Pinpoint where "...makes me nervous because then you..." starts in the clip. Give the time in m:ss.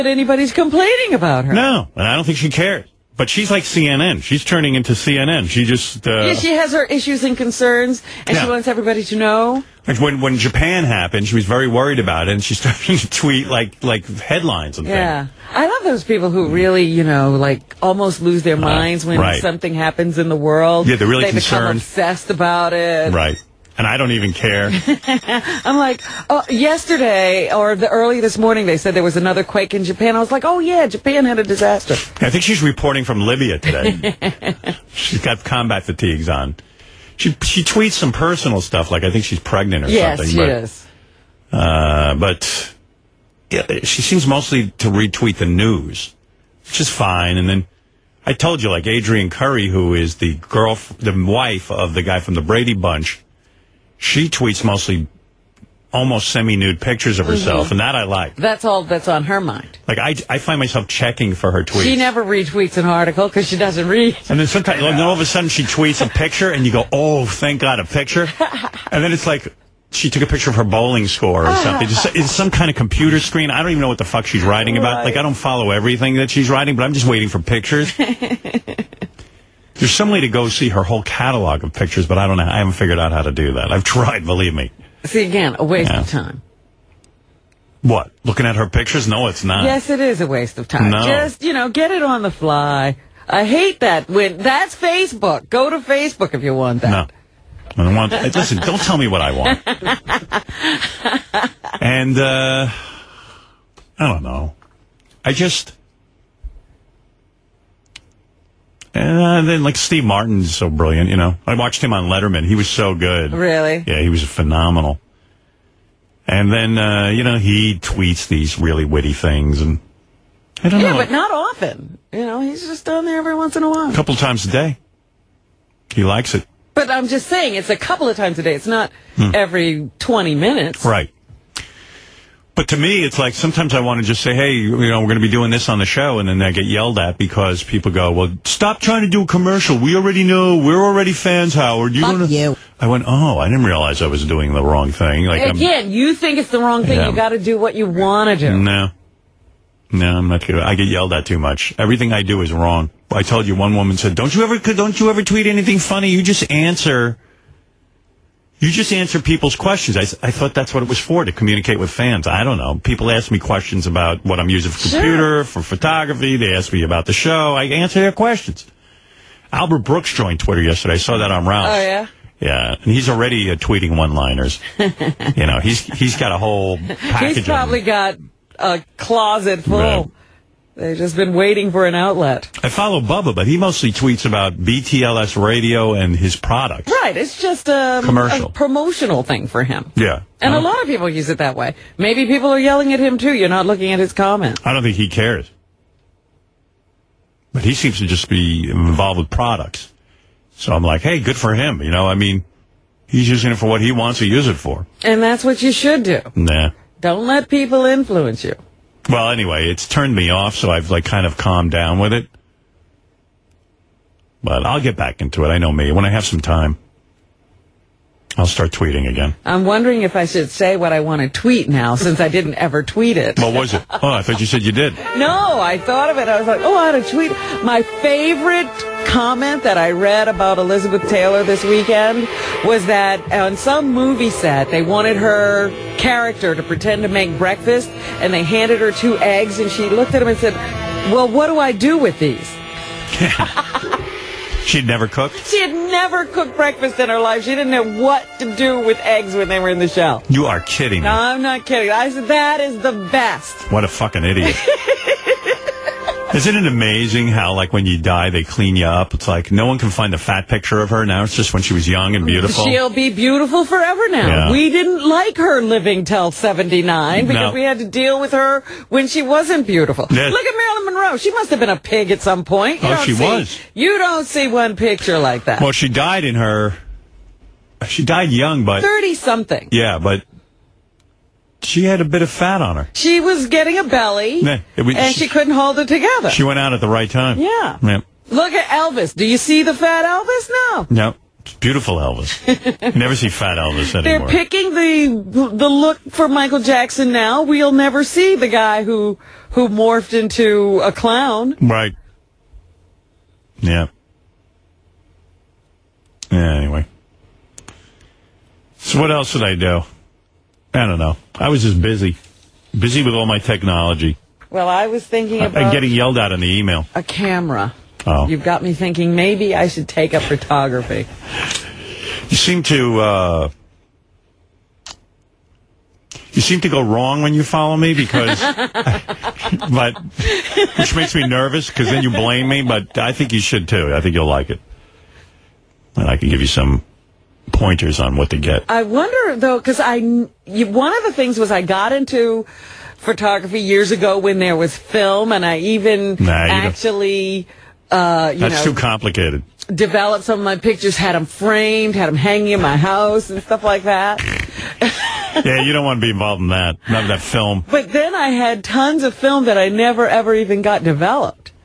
5:30.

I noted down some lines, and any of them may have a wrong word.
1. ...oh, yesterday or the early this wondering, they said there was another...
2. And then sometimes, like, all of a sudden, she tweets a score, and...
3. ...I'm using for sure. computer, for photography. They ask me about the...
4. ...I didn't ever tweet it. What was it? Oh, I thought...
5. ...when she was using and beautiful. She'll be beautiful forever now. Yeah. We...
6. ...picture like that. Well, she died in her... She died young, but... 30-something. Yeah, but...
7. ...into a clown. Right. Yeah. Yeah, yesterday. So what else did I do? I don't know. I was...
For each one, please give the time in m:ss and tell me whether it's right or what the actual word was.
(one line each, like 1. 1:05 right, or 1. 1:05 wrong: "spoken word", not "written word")
1. 0:26 wrong: "morning", not "wondering"
2. 1:04 wrong: "picture", not "score"
3. 2:44 right
4. 3:42 right
5. 4:21 wrong: "young", not "using"
6. 4:34 right
7. 5:00 wrong: "anyway", not "yesterday".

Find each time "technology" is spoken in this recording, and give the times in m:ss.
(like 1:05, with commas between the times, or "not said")
5:13.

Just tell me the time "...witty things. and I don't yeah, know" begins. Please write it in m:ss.
1:58.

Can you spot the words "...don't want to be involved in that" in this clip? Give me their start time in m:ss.
5:55.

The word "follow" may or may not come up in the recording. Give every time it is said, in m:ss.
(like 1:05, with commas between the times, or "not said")
1:15, 3:02, 5:27.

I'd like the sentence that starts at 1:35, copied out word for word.
Go to Facebook if you want that.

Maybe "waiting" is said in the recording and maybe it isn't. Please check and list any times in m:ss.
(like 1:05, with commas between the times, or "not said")
1:17, 3:01.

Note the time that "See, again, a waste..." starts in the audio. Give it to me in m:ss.
1:25.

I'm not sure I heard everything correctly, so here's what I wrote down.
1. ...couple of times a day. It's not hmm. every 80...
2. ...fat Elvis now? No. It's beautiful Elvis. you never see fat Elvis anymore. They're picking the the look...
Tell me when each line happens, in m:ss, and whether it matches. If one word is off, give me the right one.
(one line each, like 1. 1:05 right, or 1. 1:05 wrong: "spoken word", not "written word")
1. 2:07 wrong: "20", not "80"
2. 4:49 right.